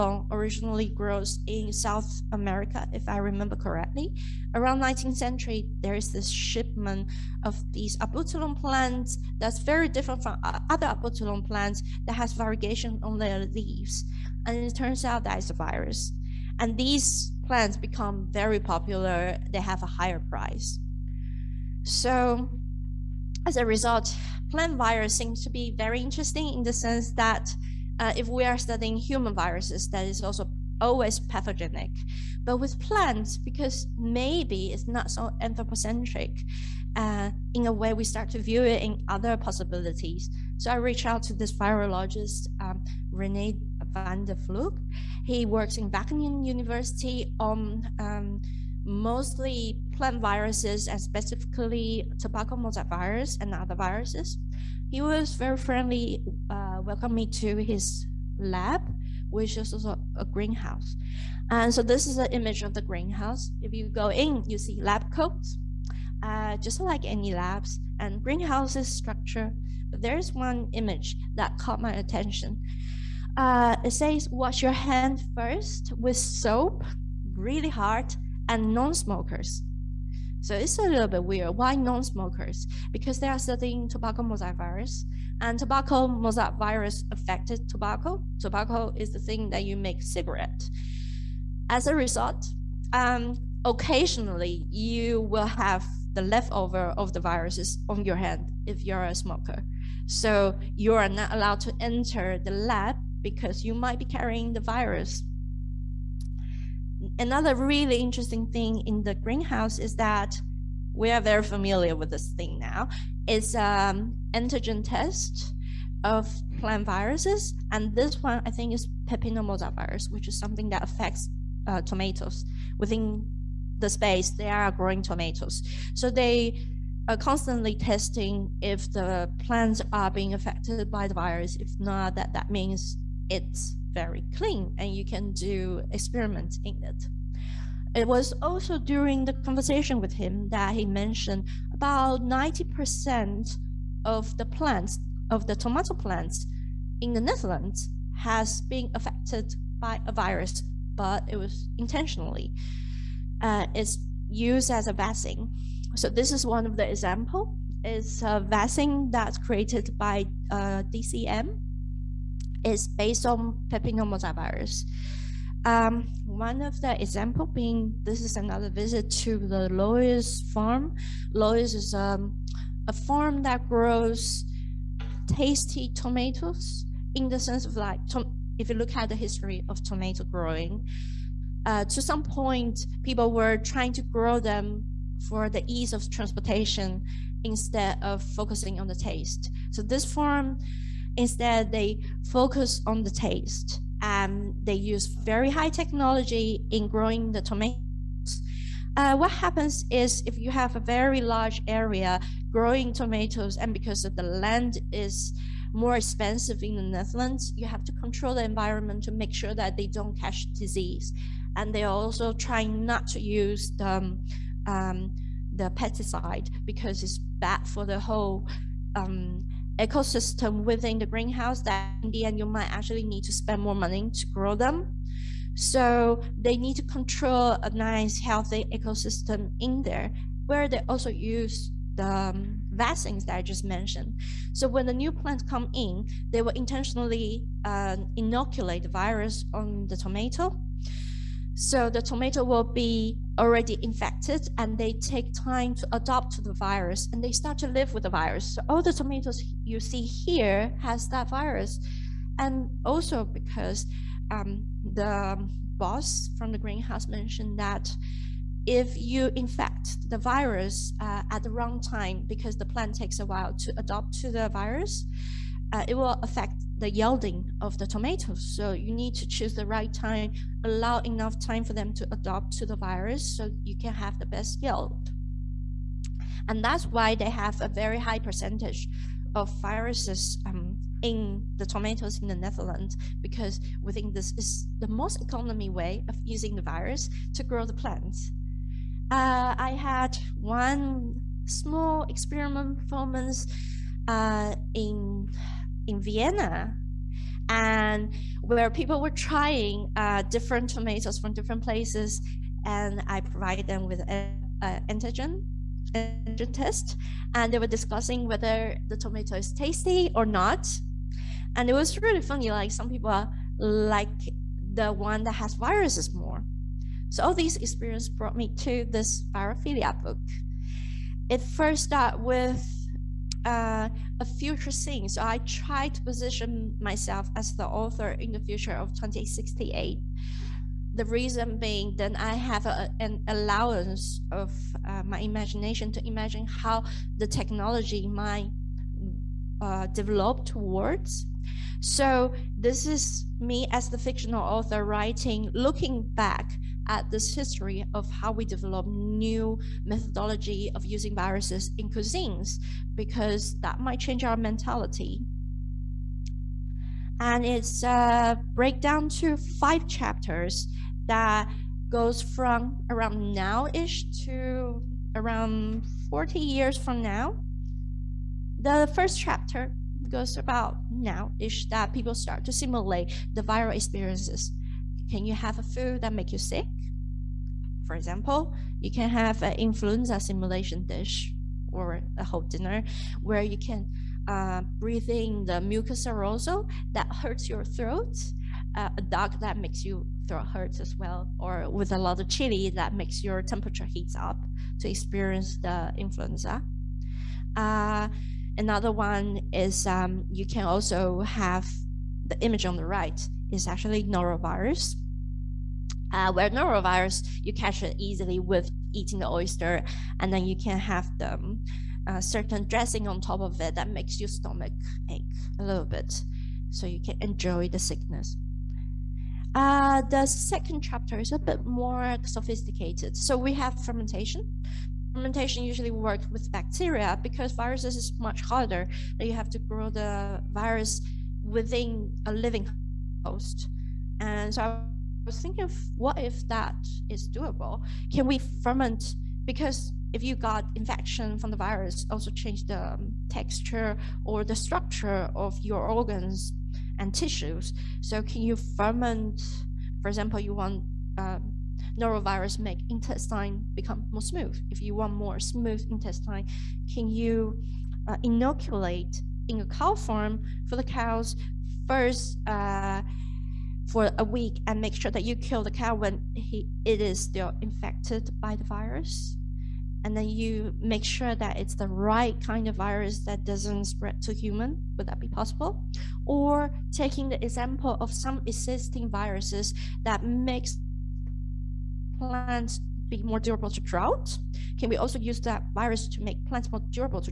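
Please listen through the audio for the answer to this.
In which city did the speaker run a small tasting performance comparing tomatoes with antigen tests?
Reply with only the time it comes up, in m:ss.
4:56.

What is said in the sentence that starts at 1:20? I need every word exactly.
So it's a little bit weird.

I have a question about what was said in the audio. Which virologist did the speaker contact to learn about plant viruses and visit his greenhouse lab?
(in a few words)
Rene van der Vlugt.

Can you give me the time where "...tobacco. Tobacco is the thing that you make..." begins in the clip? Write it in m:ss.
1:27.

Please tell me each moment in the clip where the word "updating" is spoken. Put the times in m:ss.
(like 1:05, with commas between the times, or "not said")
not said.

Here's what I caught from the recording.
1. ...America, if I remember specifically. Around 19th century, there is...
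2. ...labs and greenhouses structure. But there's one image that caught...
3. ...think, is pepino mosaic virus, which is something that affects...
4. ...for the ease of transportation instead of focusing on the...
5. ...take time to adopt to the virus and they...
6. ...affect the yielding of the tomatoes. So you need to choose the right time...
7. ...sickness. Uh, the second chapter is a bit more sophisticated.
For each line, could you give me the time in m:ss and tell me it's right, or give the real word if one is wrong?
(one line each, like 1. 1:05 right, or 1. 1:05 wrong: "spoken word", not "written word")
1. 0:02 wrong: "correctly", not "specifically"
2. 1:07 right
3. 1:58 right
4. 3:05 right
5. 4:04 right
6. 4:26 right
7. 6:57 right.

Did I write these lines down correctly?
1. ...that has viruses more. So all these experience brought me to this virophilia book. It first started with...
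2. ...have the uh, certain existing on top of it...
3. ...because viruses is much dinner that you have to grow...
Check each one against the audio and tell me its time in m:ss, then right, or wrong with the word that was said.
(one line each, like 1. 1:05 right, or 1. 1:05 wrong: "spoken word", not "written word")
1. 5:15 right
2. 6:50 wrong: "dressing", not "existing"
3. 7:07 wrong: "harder", not "dinner".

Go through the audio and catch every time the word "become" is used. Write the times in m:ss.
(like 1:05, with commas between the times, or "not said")
0:17, 7:33.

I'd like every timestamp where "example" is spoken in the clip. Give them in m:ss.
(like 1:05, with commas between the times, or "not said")
2:36, 2:47, 6:17, 7:30, 7:57.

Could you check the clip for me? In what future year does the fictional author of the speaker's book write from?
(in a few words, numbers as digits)
2068.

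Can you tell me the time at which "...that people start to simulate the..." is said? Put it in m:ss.
6:11.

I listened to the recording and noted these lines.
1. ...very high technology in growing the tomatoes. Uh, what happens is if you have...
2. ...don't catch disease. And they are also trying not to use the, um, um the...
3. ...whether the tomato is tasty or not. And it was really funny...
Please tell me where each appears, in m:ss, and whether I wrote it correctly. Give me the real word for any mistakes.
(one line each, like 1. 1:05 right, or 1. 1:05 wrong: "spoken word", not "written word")
1. 3:15 right
2. 3:29 right
3. 5:08 right.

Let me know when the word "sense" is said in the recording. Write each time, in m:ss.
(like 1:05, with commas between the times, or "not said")
0:26, 2:57.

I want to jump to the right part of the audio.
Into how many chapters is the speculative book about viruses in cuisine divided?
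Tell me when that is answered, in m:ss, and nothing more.
5:59.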